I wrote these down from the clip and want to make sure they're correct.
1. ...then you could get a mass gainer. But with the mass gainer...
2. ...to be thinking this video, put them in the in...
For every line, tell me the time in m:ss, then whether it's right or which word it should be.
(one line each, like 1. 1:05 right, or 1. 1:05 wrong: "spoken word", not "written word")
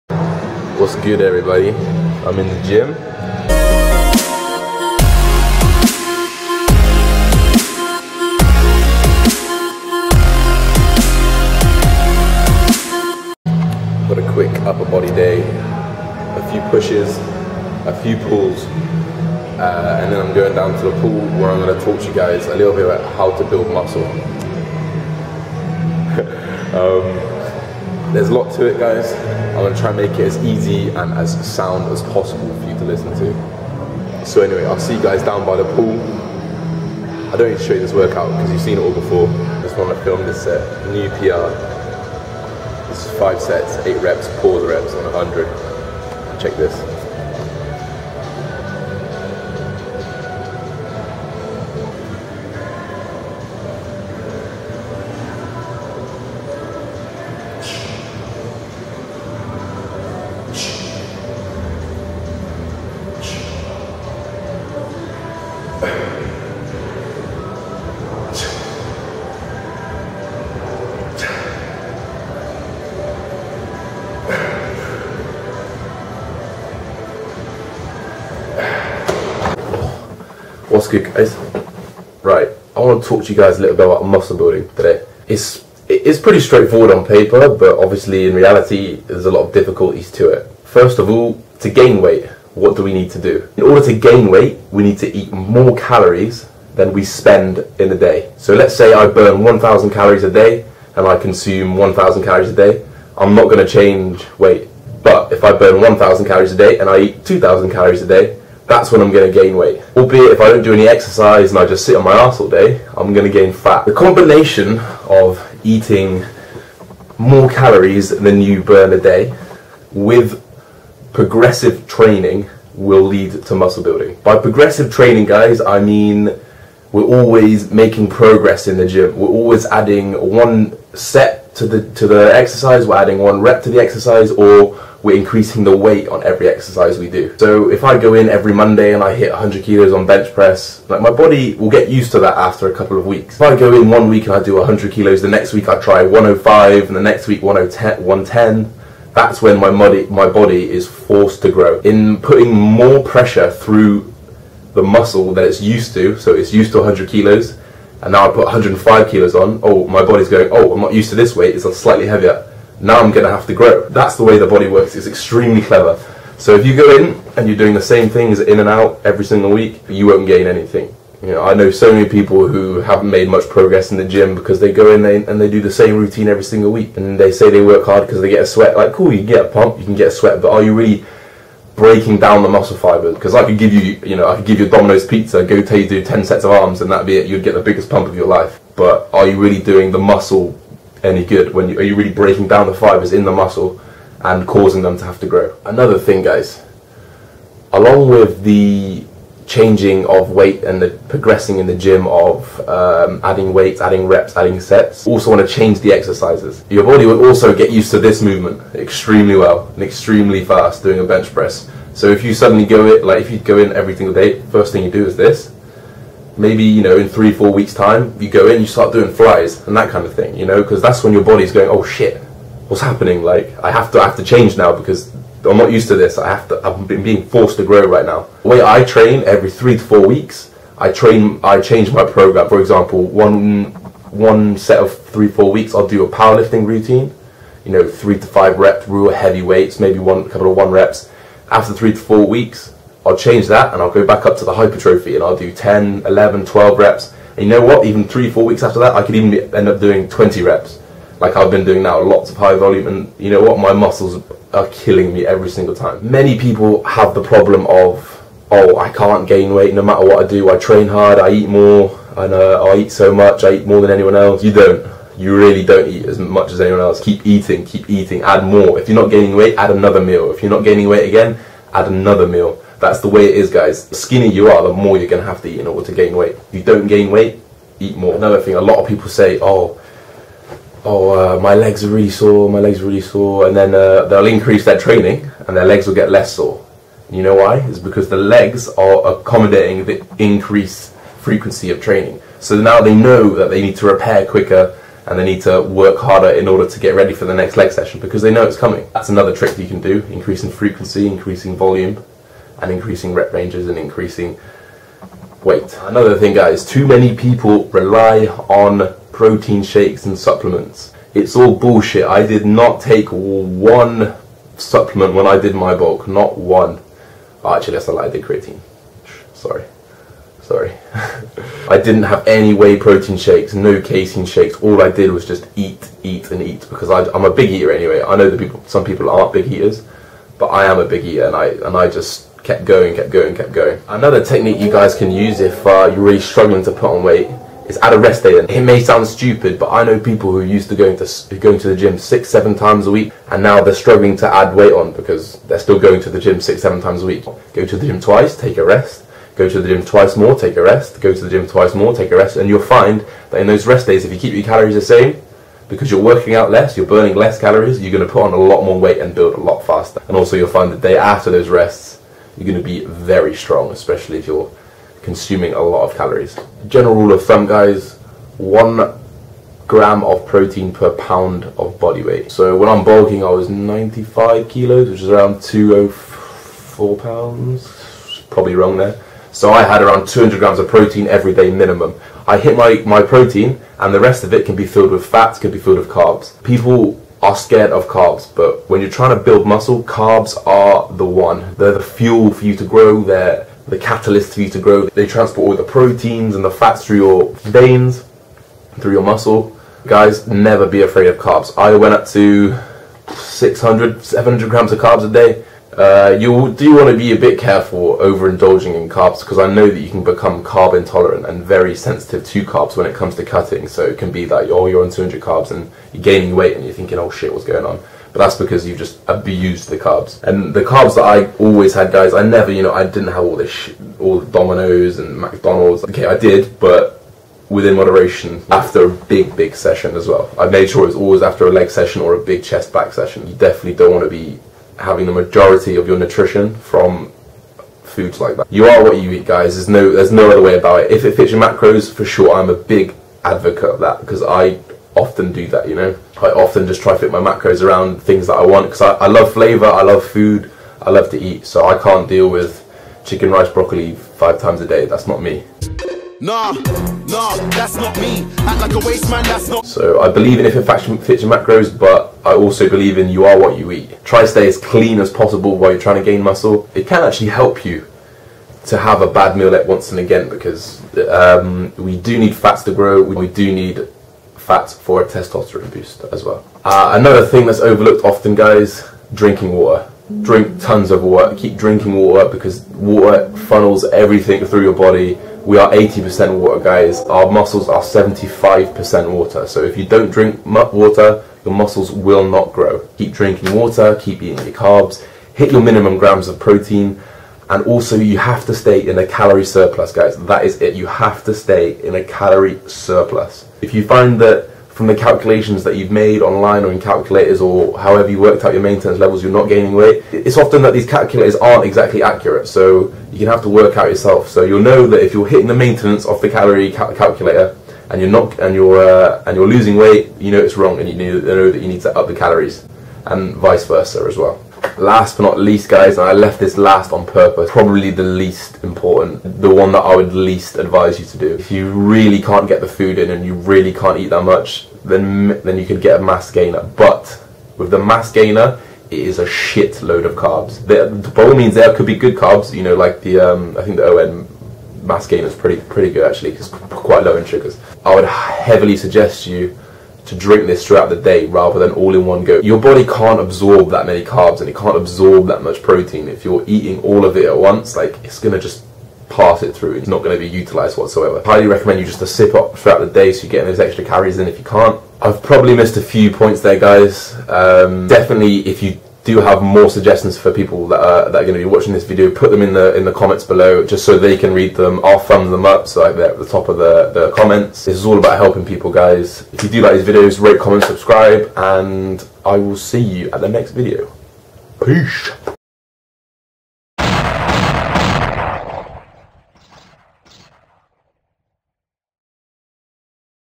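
1. 8:55 right
2. 9:31 wrong: "watching", not "thinking".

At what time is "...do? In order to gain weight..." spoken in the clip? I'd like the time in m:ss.
1:33.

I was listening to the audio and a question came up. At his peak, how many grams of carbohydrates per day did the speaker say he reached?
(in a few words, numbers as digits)
600 to 700 grams.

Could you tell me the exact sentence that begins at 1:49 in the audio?
Albeit if I don't do any exercise and I just sit on my ass all day, I'm going to gain fat.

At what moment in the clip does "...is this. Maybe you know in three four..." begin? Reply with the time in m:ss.
3:35.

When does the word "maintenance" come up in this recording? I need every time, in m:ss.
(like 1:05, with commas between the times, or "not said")
8:28, 8:35.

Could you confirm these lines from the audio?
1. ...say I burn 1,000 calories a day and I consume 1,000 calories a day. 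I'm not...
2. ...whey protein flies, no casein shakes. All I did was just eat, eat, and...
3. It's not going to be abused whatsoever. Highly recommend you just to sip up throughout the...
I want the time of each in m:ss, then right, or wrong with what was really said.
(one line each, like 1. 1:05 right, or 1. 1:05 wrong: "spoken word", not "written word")
1. 1:38 right
2. 5:22 wrong: "shakes", not "flies"
3. 9:19 wrong: "utilized", not "abused".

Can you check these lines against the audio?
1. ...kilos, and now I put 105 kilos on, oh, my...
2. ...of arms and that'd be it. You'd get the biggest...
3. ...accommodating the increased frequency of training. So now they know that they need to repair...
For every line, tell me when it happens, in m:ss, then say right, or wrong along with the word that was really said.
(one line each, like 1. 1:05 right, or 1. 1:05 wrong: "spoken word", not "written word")
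1. 2:37 right
2. 3:06 right
3. 4:49 right.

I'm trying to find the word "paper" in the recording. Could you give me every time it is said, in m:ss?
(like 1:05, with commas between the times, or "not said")
1:27.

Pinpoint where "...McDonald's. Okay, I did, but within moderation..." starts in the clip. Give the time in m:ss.
7:05.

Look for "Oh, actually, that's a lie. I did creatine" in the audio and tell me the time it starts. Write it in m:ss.
5:17.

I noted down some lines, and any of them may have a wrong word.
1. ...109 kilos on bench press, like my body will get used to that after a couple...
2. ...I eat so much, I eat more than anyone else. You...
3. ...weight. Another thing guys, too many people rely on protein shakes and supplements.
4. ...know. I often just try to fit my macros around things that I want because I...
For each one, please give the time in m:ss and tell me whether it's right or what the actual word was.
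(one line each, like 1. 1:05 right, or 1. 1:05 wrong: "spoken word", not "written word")
1. 2:19 wrong: "100", not "109"
2. 4:22 right
3. 5:05 right
4. 7:25 right.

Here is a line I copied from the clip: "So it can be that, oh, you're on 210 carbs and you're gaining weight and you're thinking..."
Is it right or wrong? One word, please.
wrong.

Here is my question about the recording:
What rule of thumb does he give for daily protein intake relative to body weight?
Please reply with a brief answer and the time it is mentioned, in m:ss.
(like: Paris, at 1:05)
1 gram per pound, at 6:08.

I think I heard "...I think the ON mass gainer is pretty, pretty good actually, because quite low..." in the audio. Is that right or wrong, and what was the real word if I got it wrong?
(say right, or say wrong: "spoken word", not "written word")
right.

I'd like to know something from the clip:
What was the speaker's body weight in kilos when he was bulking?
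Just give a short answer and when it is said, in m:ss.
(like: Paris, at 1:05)
95 kilos, at 6:13.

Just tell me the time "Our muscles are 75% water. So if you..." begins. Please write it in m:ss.
8:07.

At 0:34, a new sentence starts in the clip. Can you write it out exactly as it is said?
So anyway, I'll see you guys down by the pool.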